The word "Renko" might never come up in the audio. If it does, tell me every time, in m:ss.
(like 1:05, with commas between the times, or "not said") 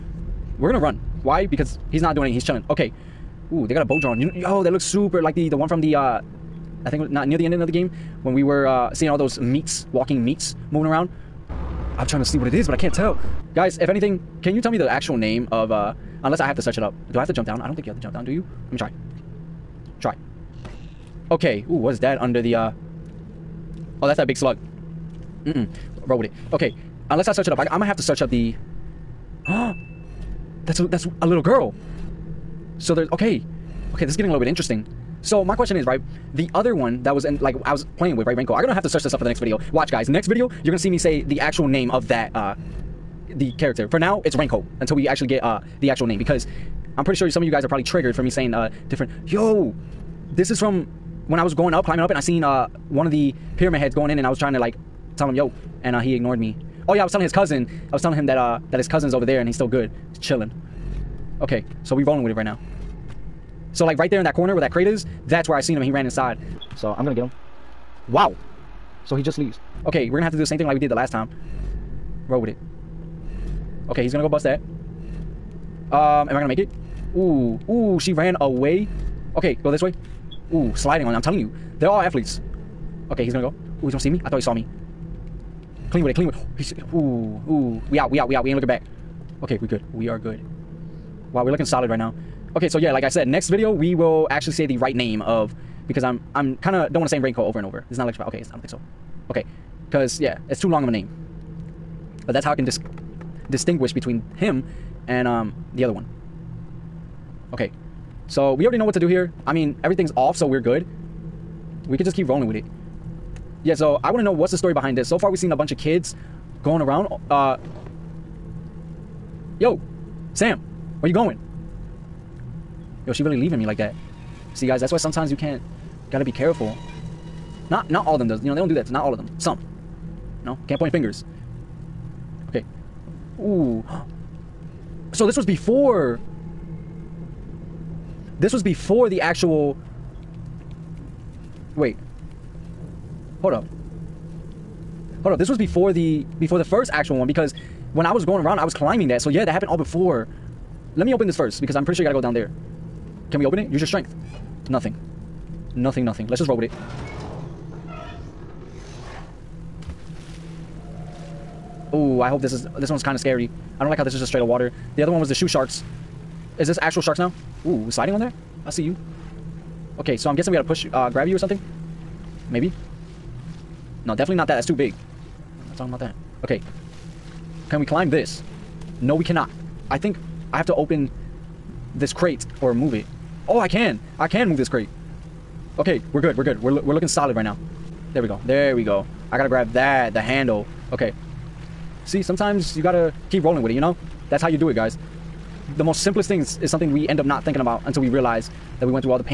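0:38, 0:44.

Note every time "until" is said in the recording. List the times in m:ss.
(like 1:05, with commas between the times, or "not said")
0:44, 3:17.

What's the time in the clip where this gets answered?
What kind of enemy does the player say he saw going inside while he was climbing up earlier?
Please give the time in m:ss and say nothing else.
0:53.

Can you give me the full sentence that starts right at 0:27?
I, am going to have to search up the...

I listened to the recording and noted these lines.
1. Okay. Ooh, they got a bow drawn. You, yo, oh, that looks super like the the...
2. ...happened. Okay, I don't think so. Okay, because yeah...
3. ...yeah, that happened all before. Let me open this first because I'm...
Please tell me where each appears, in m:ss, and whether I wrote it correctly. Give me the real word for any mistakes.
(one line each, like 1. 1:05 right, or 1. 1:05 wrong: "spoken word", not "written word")
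1. 0:02 right
2. 1:38 wrong: "electrified", not "happened"
3. 2:29 right.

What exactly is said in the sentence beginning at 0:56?
Oh yeah, I was telling his cousin.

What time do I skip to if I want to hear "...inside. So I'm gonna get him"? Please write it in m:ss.
1:06.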